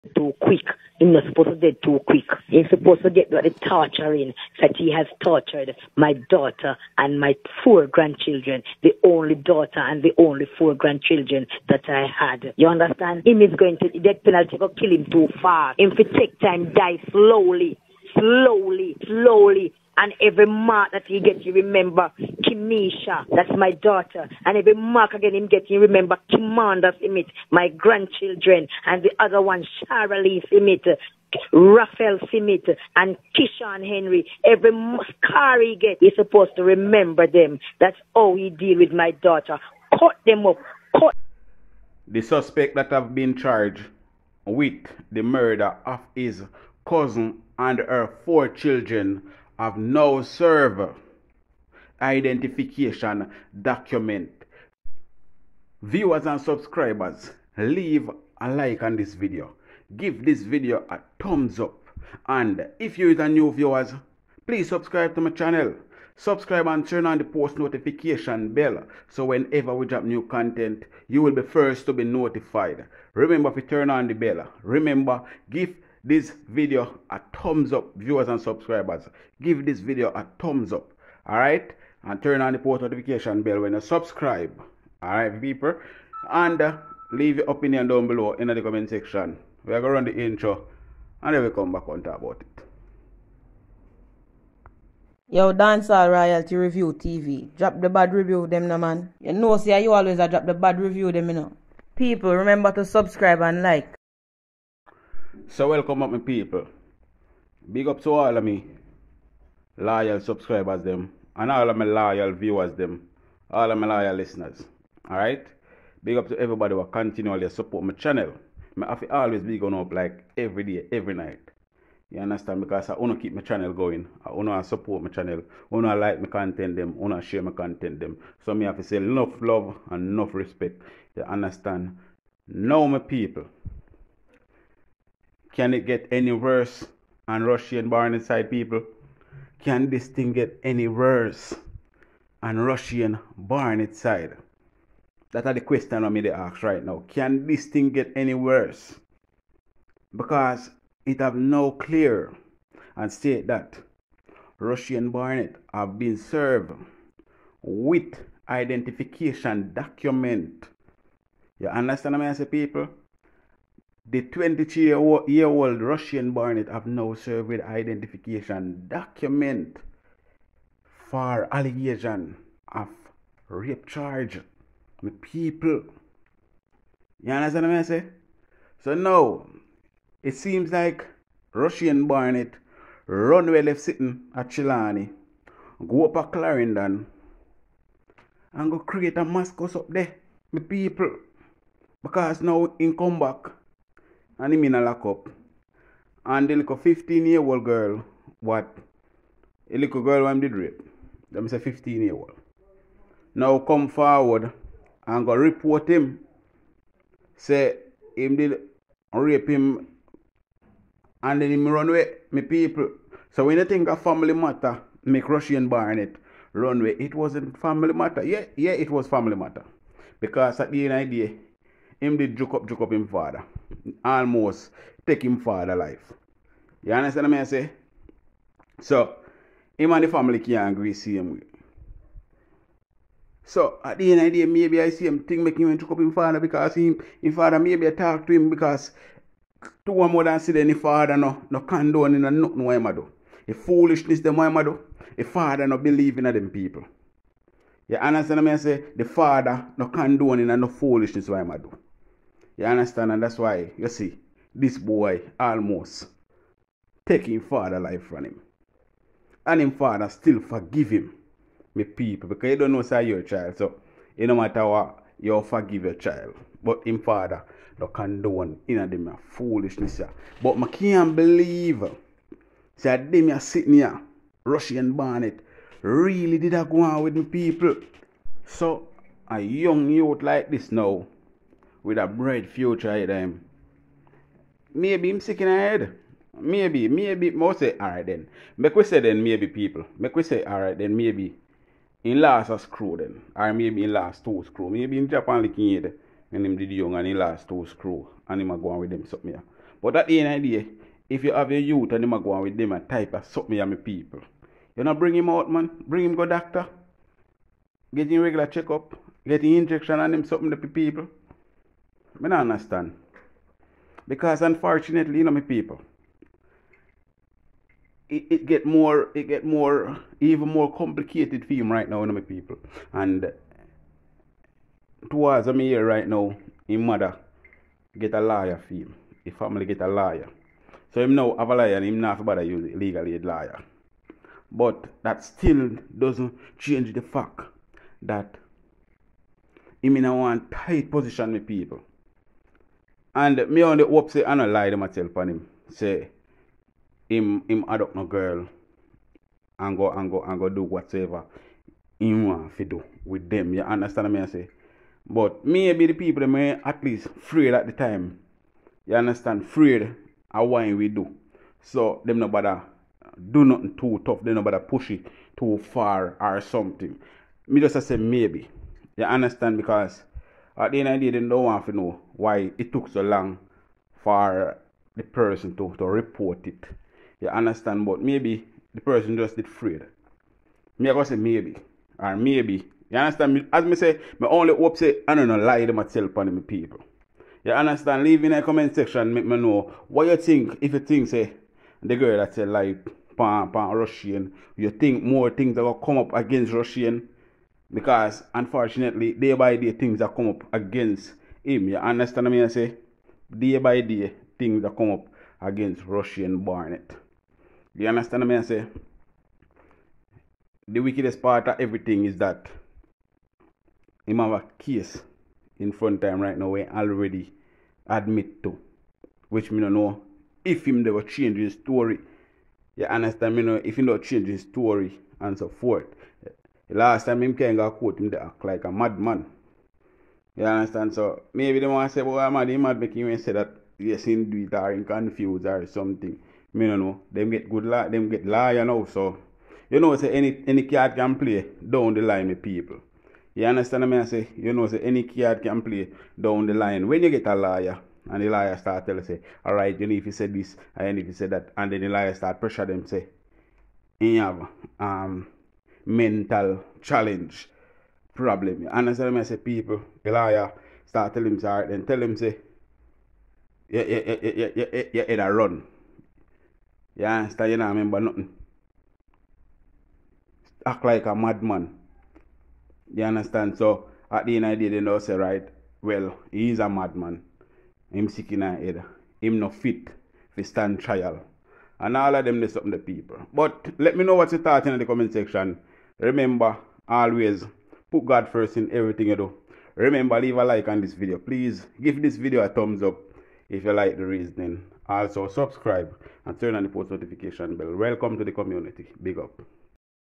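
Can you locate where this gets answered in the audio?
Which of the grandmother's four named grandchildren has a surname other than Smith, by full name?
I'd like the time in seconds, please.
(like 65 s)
33 s.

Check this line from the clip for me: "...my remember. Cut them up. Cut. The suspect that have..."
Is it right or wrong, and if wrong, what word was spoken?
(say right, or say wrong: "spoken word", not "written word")
wrong: "daughter", not "remember".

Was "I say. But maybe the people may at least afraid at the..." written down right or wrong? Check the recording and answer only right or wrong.
right.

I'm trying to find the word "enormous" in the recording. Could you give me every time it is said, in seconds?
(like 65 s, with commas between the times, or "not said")
not said.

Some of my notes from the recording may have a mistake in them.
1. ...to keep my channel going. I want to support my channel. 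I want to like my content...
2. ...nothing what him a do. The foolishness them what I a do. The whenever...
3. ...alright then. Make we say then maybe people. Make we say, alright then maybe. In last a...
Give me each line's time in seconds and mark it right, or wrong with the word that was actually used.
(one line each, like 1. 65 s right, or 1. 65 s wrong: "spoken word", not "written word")
1. 123 s right
2. 242 s wrong: "father", not "whenever"
3. 287 s right.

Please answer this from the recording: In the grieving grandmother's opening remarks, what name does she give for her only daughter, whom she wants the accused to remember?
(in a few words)
Kimisha.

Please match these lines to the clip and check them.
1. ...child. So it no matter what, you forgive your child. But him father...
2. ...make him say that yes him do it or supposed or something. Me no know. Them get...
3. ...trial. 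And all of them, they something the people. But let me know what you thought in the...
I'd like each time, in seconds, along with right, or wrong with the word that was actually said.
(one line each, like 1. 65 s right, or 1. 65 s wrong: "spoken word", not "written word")
1. 263 s right
2. 432 s wrong: "confused", not "supposed"
3. 480 s right.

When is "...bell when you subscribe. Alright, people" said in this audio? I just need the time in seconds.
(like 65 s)
83 s.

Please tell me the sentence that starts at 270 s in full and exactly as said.
But I can't believe say them are sitting here, Rushane Barnett really did a go on with me people.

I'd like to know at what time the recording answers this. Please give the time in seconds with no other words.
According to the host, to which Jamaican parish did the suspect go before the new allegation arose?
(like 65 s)
186 s.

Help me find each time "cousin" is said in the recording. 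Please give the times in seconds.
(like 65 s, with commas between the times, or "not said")
46 s.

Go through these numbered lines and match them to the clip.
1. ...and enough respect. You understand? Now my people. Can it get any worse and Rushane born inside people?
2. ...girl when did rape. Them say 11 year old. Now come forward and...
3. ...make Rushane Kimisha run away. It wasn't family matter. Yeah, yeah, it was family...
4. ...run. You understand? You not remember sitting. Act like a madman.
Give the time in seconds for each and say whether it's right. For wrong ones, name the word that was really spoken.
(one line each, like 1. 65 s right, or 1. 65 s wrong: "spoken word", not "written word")
1. 129 s right
2. 200 s wrong: "15", not "11"
3. 215 s wrong: "Barnett", not "Kimisha"
4. 465 s wrong: "nothing", not "sitting".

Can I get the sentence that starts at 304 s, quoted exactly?
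You know, bring him out, man.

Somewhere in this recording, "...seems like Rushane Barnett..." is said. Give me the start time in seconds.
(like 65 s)
180 s.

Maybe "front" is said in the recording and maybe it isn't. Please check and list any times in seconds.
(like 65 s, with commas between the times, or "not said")
415 s.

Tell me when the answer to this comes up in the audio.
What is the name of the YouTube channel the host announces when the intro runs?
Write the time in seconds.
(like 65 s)
95 s.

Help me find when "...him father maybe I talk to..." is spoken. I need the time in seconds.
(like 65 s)
237 s.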